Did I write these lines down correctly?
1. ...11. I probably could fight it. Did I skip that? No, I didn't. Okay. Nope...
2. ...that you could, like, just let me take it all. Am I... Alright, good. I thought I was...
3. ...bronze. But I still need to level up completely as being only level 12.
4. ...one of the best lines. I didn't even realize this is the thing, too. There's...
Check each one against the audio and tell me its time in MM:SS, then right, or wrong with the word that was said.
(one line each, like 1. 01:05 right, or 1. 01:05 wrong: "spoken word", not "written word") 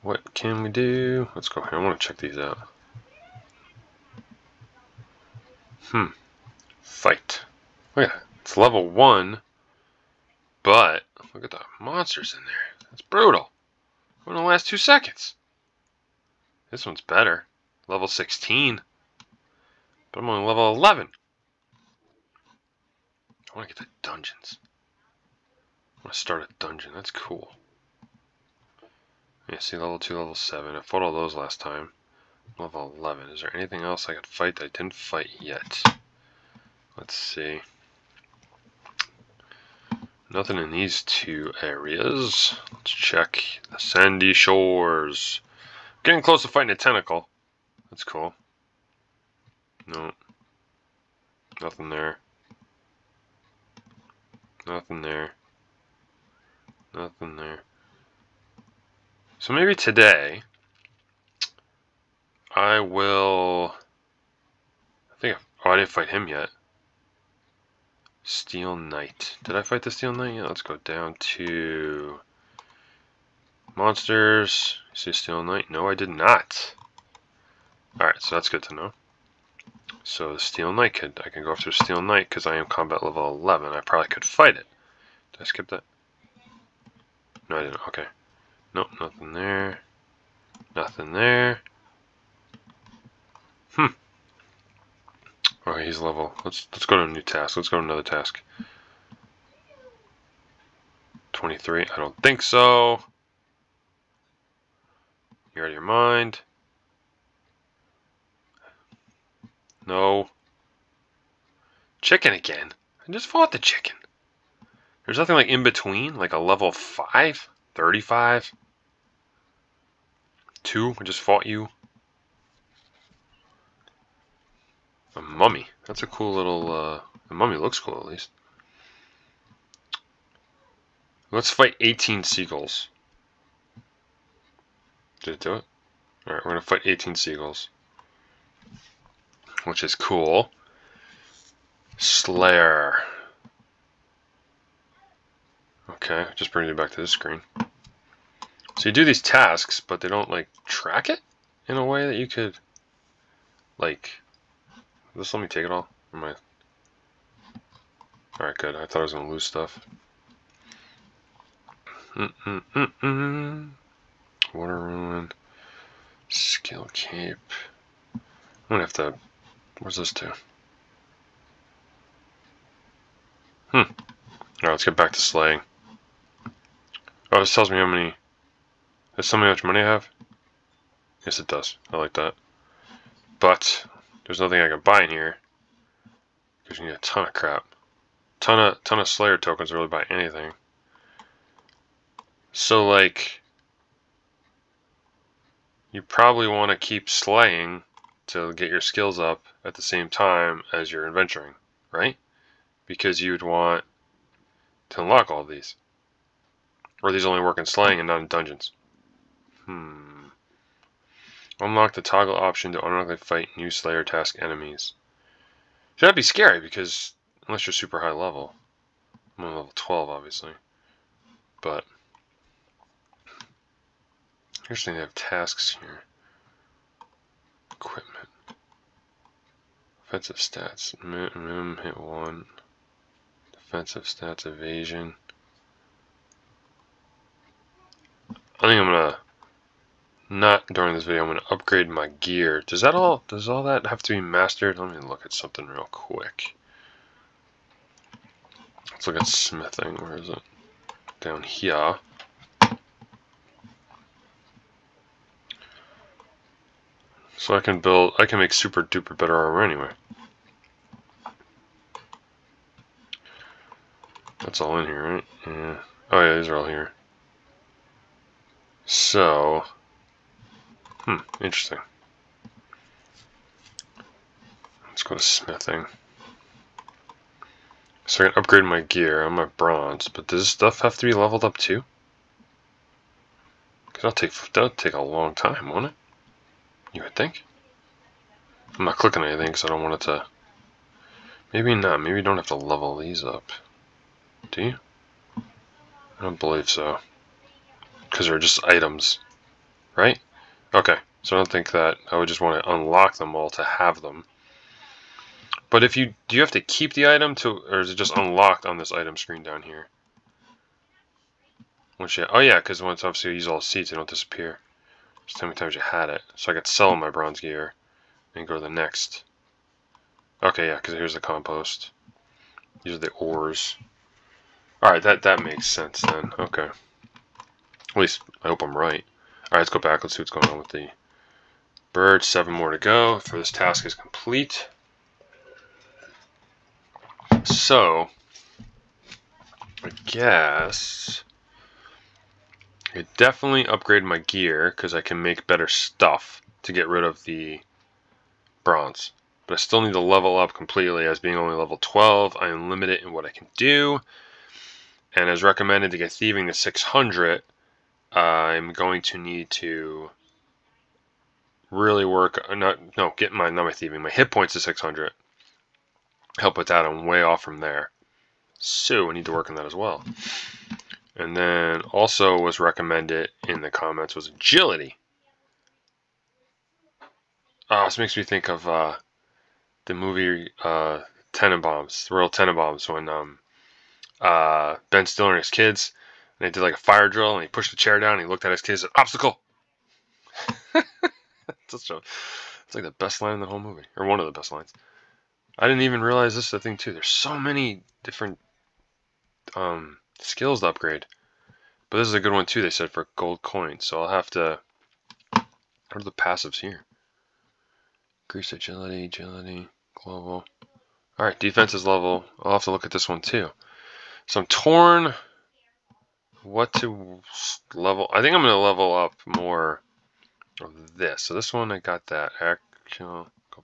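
1. 01:23 right
2. 02:32 right
3. 05:48 right
4. 06:34 right.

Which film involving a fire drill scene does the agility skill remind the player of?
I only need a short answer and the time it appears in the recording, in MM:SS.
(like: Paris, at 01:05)
The Royal Tenenbaums, at 06:22.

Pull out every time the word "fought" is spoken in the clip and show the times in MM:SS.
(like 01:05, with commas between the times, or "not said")
00:30, 01:53, 02:01.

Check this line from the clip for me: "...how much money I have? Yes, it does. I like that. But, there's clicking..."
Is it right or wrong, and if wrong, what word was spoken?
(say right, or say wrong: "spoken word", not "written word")
wrong: "nothing", not "clicking".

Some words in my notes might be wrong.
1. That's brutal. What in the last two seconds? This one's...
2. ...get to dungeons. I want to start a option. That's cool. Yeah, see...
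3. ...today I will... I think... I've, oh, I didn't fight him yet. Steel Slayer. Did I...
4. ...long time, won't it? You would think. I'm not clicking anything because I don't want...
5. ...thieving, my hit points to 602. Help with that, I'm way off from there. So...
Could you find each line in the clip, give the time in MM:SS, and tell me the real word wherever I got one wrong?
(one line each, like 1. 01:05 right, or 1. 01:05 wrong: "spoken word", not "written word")
1. 00:12 right
2. 00:23 wrong: "dungeon", not "option"
3. 00:59 wrong: "Knight", not "Slayer"
4. 04:45 right
5. 06:03 wrong: "600", not "602".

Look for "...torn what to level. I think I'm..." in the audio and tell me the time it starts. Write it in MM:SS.
06:54.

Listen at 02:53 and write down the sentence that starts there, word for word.
Alright, let's get back to slaying.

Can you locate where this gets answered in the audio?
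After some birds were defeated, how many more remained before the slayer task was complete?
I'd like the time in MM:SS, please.
05:32.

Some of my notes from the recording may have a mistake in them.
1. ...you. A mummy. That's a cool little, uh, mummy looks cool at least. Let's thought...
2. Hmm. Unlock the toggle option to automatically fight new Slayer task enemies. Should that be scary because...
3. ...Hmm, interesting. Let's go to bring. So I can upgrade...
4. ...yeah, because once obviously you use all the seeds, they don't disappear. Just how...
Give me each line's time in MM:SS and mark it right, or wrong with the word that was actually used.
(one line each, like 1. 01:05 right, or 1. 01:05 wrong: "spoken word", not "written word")
1. 02:01 wrong: "fight", not "thought"
2. 03:29 right
3. 04:31 wrong: "smithing", not "bring"
4. 05:12 right.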